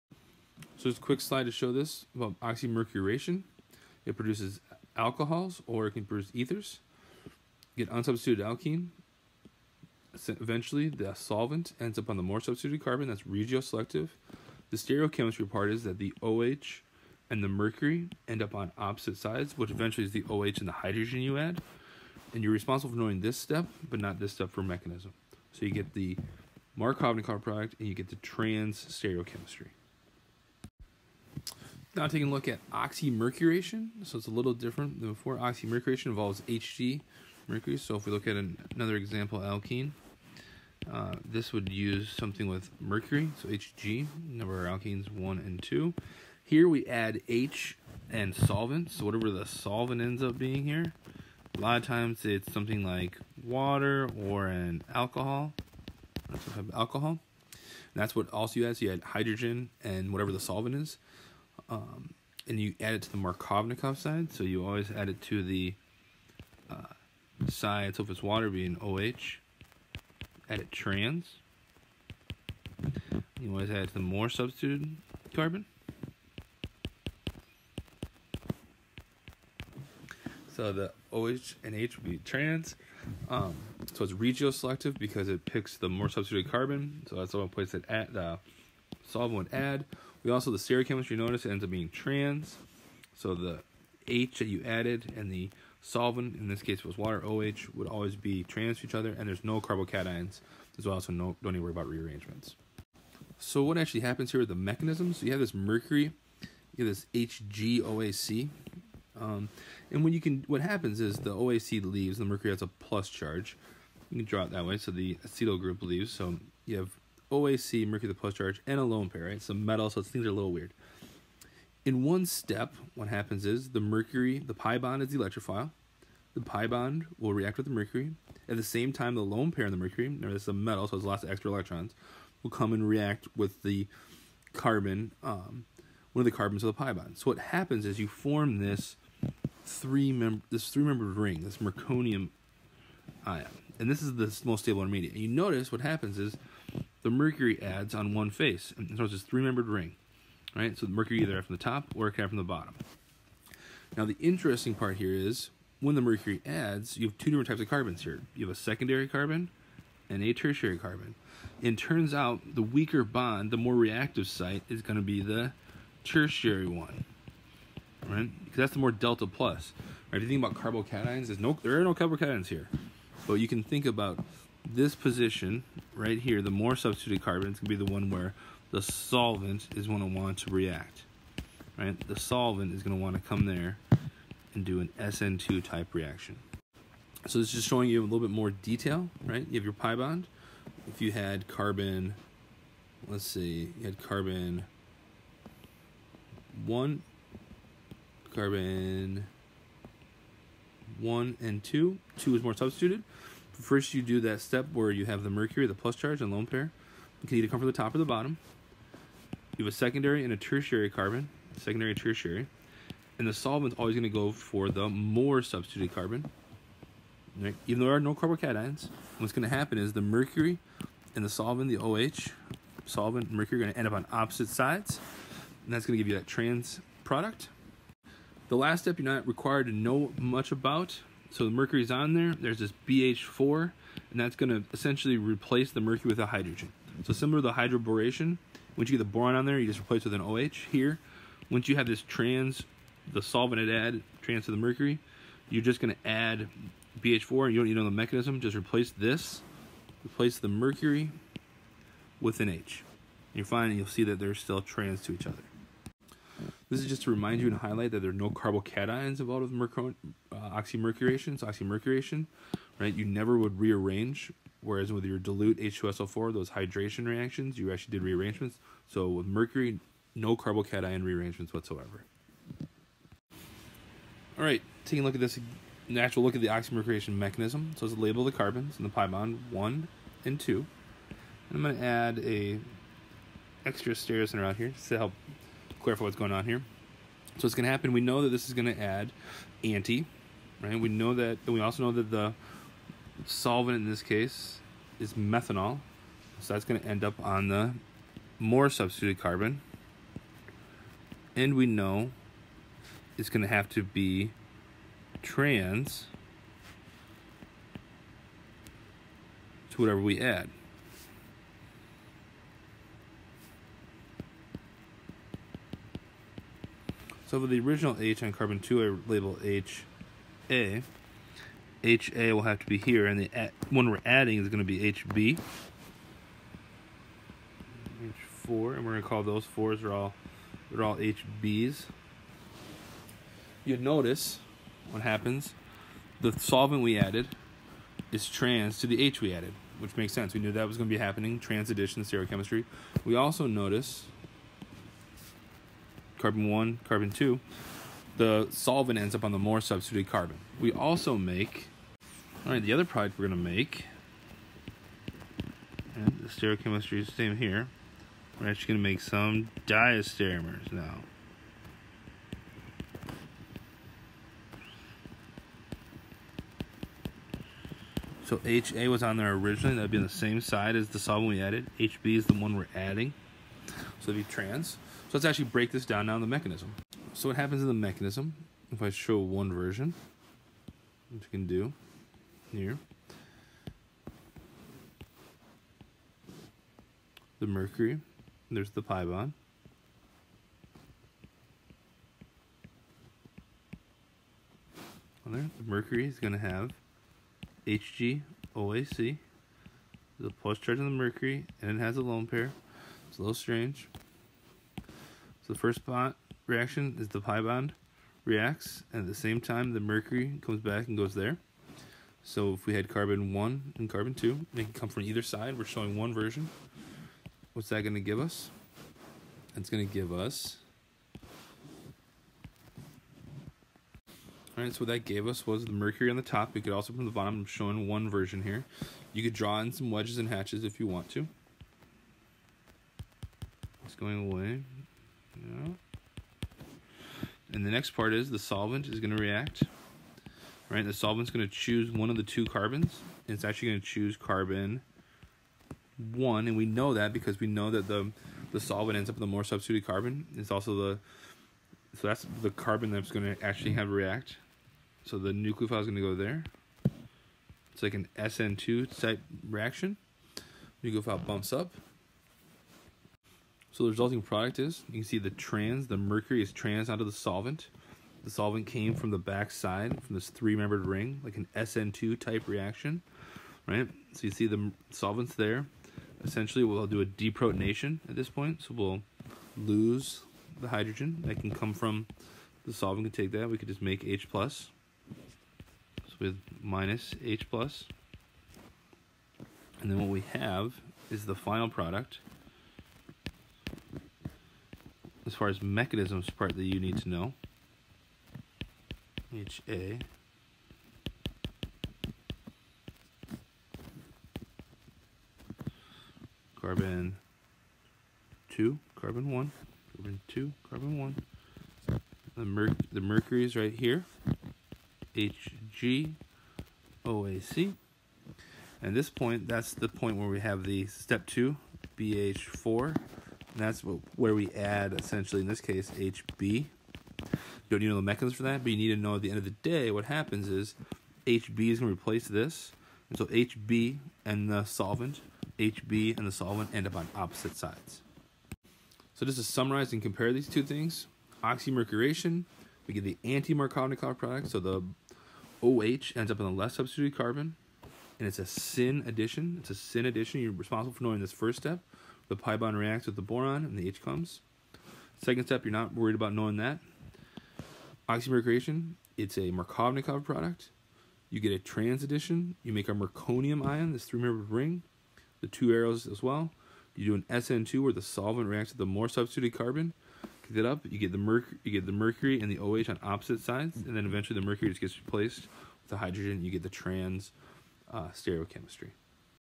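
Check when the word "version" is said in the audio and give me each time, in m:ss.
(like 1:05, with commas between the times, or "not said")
6:19, 6:56, 7:08.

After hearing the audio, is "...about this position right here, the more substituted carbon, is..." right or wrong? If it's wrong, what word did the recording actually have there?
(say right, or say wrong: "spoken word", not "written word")
right.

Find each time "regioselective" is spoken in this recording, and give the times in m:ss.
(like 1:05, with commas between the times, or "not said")
0:13, 1:24.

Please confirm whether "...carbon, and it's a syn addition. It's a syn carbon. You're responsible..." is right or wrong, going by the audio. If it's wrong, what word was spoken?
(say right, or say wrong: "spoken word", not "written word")
wrong: "addition", not "carbon".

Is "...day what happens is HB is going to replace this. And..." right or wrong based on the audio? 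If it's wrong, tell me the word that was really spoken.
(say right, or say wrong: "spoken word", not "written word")
right.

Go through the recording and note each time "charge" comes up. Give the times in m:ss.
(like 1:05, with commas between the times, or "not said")
1:53, 1:58, 3:25, 6:40.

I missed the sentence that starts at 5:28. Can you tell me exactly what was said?
H4, and we're going to call those fours are all they're all HBs.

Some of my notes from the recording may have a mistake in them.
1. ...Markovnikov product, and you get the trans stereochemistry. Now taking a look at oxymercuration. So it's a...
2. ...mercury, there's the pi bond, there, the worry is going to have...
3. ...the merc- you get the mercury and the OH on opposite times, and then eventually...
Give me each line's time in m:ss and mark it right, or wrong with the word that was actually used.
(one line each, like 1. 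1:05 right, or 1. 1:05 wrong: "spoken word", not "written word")
1. 0:26 right
2. 6:27 wrong: "mercury", not "worry"
3. 9:31 wrong: "sides", not "times".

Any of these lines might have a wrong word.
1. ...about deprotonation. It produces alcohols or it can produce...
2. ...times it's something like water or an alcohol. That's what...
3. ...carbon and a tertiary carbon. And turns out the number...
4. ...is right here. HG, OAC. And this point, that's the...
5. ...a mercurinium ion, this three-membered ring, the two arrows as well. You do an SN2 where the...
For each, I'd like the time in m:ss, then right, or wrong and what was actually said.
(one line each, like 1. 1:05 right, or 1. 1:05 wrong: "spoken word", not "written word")
1. 0:02 wrong: "oxymercuration", not "deprotonation"
2. 0:51 right
3. 2:39 wrong: "weaker", not "number"
4. 8:33 right
5. 9:22 right.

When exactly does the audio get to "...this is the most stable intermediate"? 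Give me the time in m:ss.
2:23.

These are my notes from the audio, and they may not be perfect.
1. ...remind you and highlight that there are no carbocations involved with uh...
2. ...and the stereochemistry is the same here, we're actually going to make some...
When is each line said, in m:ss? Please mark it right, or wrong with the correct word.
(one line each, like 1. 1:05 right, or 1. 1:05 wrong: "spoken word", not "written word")
1. 4:17 right
2. 5:55 right.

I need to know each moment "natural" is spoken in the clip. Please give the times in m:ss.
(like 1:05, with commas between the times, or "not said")
4:35.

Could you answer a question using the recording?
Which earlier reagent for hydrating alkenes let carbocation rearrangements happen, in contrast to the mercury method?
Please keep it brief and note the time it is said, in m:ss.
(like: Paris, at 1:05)
dilute H2SO4, at 4:25.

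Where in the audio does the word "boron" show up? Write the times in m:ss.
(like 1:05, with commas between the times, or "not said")
3:59, 9:13.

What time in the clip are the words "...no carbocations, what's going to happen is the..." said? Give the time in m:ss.
3:37.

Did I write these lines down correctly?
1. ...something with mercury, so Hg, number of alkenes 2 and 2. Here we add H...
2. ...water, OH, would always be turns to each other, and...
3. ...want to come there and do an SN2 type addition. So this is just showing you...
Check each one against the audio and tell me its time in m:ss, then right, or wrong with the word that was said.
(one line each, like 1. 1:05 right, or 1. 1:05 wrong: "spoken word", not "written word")
1. 0:42 wrong: "1", not "2"
2. 1:36 wrong: "trans", not "turns"
3. 3:03 wrong: "reaction", not "addition".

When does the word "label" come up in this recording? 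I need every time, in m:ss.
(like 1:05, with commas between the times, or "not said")
4:37, 5:19.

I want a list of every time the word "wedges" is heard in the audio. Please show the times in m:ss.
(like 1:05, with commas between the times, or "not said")
7:09.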